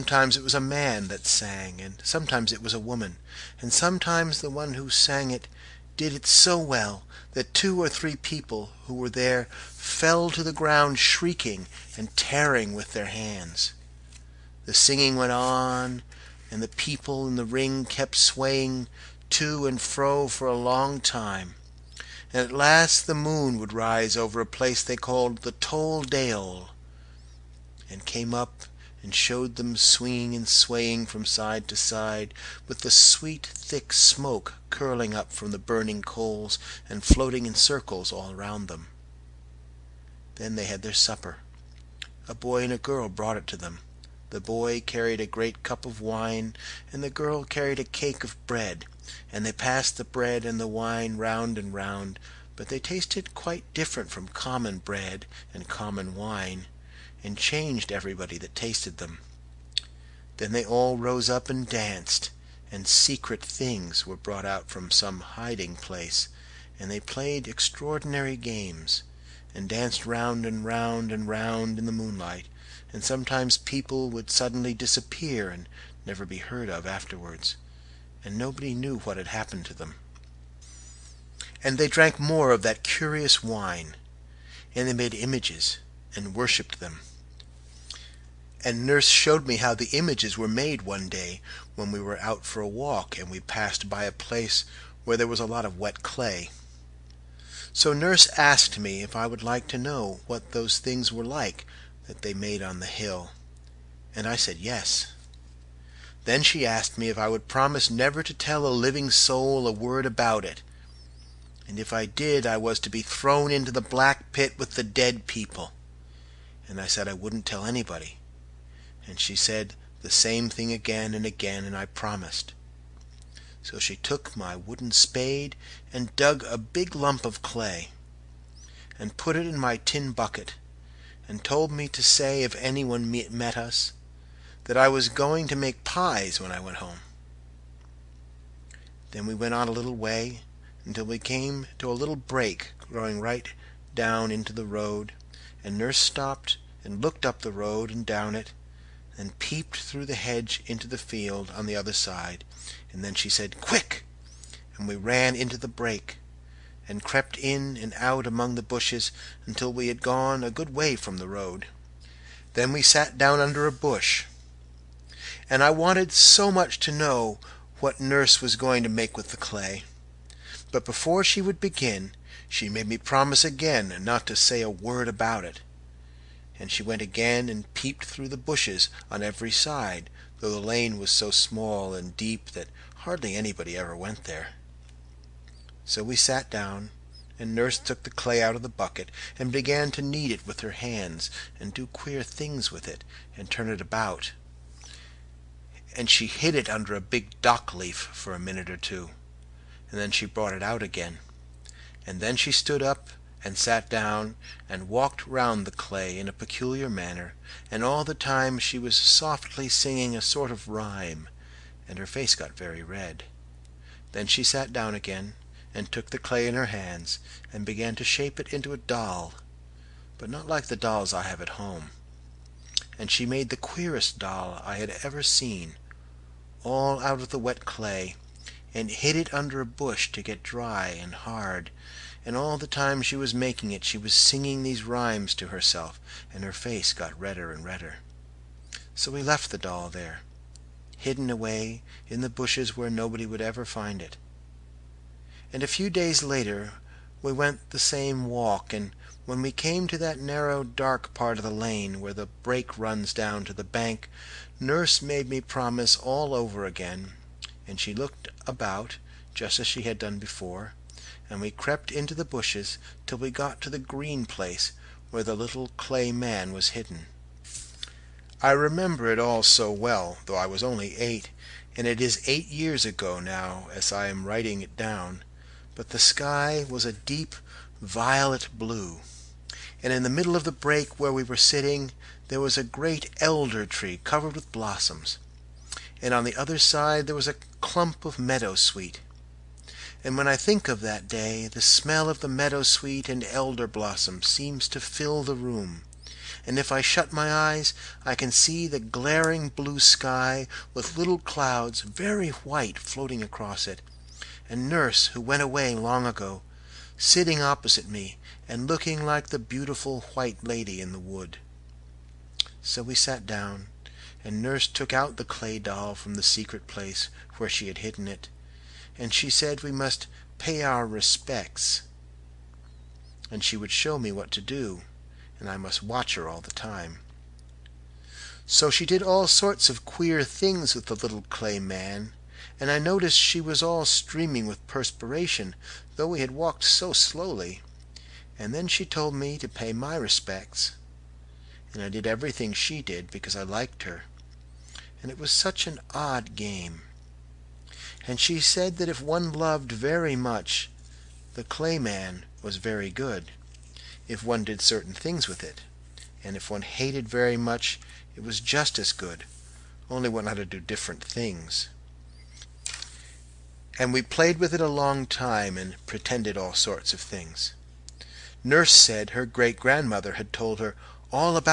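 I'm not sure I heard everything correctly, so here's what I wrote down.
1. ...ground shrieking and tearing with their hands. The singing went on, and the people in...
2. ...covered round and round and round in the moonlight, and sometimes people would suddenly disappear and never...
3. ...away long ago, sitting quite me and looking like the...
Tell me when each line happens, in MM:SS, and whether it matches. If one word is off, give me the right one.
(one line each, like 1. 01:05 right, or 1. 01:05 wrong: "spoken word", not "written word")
1. 00:10 right
2. 01:09 wrong: "danced", not "covered"
3. 05:05 wrong: "opposite", not "quite".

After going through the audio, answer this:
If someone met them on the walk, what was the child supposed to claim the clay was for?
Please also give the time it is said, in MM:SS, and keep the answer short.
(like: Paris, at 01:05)
make pies, at 02:15.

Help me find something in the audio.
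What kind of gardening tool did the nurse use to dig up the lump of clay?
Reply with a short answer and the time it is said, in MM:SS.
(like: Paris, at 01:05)
wooden spade, at 02:04.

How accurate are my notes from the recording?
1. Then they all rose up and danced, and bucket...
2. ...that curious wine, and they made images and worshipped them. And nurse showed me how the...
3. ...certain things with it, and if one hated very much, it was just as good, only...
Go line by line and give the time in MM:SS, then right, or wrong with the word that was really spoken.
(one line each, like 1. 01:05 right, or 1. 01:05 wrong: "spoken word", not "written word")
1. 01:00 wrong: "secret", not "bucket"
2. 01:22 right
3. 05:54 right.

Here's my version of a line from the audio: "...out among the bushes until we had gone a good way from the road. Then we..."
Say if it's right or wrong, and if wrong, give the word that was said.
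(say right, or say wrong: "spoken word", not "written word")
right.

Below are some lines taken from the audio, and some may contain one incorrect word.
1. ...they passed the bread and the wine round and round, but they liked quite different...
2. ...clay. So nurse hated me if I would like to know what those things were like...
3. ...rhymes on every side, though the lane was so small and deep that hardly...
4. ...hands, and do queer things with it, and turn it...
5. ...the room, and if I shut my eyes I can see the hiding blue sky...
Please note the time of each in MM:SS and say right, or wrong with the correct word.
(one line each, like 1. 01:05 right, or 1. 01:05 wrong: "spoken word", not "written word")
1. 00:49 wrong: "tasted", not "liked"
2. 01:36 wrong: "asked", not "hated"
3. 02:58 wrong: "bushes", not "rhymes"
4. 03:10 right
5. 04:55 wrong: "glaring", not "hiding".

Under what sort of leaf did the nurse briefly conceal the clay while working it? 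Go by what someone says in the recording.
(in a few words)
dock leaf.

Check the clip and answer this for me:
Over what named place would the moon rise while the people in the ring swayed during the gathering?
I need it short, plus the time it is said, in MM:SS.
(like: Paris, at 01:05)
Tole Deol, at 00:25.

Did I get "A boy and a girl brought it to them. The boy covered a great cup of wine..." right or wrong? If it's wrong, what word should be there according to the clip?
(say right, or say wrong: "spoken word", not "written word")
wrong: "carried", not "covered".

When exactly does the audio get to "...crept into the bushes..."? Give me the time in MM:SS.
04:21.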